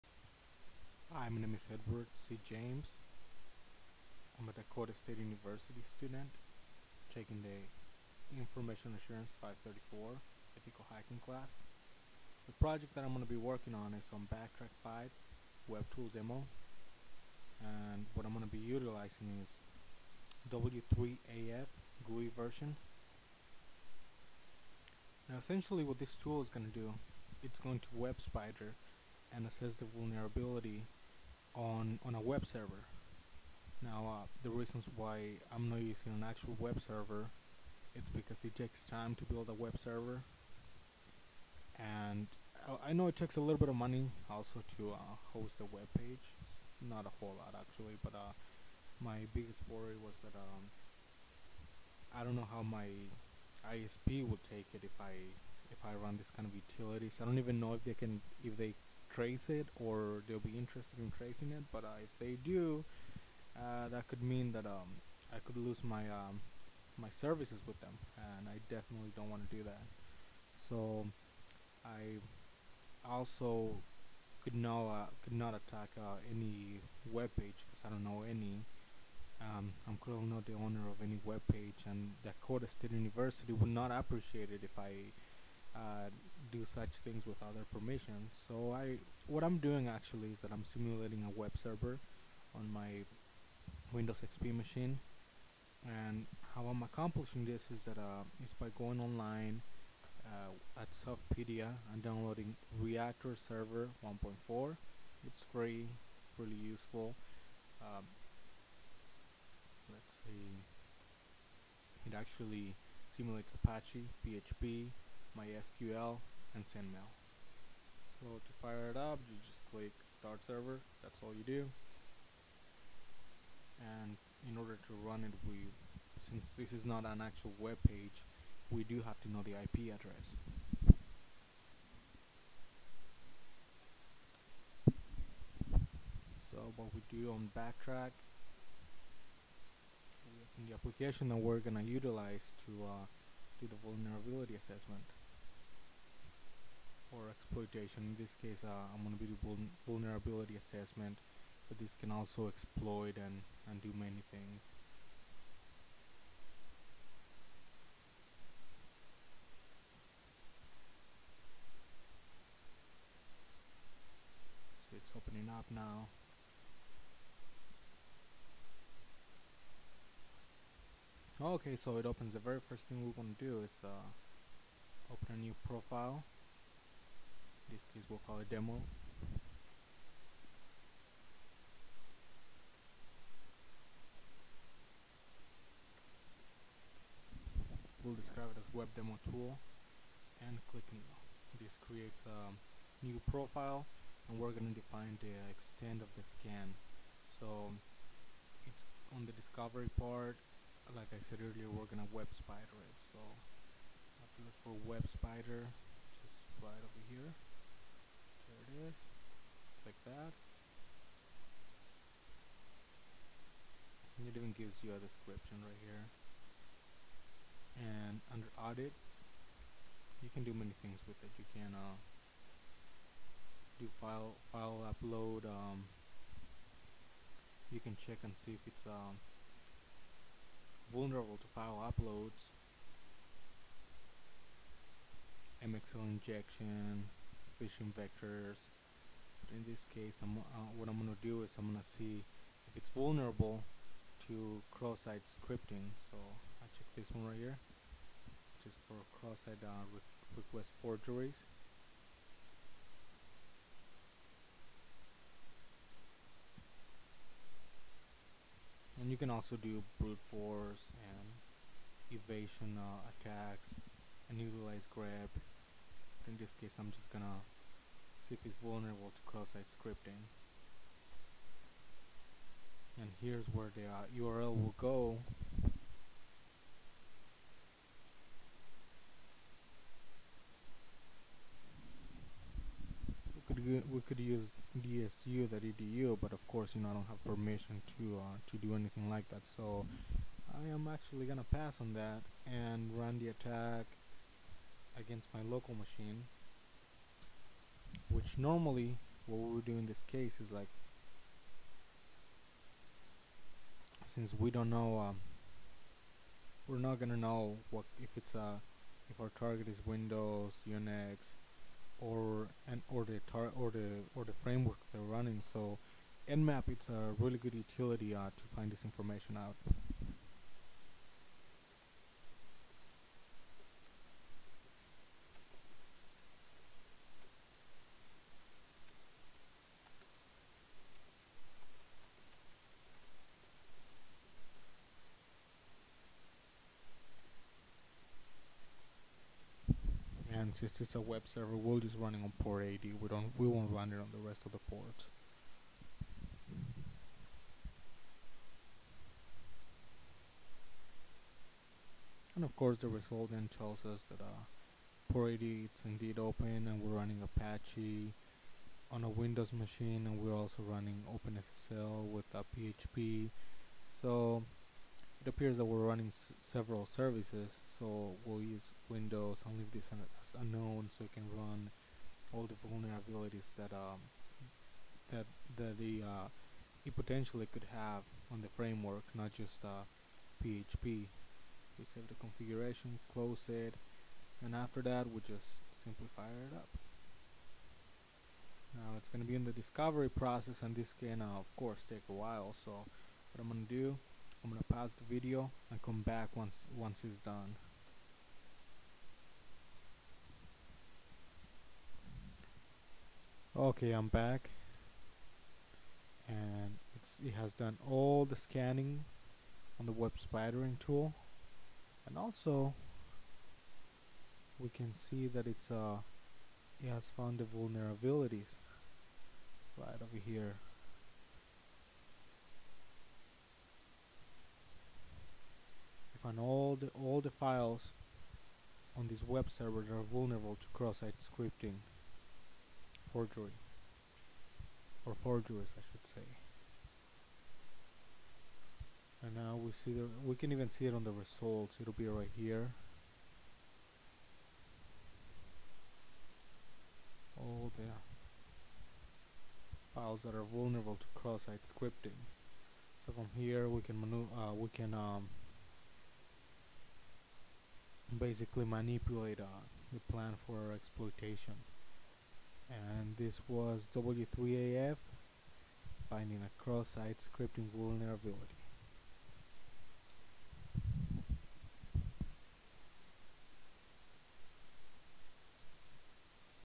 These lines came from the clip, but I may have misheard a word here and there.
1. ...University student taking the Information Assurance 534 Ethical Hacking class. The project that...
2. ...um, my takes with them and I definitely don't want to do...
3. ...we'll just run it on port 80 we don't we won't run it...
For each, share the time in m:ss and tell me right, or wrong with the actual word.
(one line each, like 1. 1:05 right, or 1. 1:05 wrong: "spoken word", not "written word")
1. 0:05 right
2. 1:06 wrong: "services", not "takes"
3. 5:41 right.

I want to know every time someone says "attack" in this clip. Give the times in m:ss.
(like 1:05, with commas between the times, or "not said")
1:15, 4:23, 4:53.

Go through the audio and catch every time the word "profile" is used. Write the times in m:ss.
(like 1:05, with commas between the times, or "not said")
2:55, 3:13.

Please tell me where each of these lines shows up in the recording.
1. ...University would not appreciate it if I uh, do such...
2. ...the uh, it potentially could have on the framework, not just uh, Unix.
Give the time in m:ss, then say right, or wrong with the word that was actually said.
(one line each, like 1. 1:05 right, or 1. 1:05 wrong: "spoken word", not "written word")
1. 1:22 right
2. 6:15 wrong: "PHP", not "Unix".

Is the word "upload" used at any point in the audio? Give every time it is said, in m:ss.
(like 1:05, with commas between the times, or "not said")
3:44, 3:51.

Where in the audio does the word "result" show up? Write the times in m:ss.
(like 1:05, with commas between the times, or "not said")
5:52, 7:21.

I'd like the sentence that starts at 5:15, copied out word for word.
So nmap it's a really good utility uh, to find this information out.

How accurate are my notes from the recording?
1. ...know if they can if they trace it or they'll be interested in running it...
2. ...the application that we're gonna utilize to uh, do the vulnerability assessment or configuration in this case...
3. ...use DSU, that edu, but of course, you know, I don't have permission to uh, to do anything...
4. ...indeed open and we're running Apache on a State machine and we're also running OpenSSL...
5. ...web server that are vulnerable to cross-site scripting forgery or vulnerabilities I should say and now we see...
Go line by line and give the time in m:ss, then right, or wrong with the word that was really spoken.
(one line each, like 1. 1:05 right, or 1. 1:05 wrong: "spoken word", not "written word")
1. 0:57 wrong: "tracing", not "running"
2. 2:20 wrong: "exploitation", not "configuration"
3. 4:44 right
4. 5:55 wrong: "Windows", not "State"
5. 7:09 wrong: "forgeries", not "vulnerabilities".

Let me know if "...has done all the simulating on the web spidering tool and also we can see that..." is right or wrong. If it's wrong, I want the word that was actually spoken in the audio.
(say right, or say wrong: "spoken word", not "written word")
wrong: "scanning", not "simulating".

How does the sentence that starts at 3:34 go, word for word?
And it even gives you a description right here.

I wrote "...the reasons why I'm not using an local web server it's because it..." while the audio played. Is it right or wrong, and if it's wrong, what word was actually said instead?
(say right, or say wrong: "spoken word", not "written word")
wrong: "actual", not "local".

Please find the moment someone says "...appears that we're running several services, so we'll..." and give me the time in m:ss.
6:05.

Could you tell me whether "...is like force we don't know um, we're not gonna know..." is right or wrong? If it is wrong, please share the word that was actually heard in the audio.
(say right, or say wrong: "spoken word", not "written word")
wrong: "since", not "force".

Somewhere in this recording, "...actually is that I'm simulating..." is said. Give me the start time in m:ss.
1:29.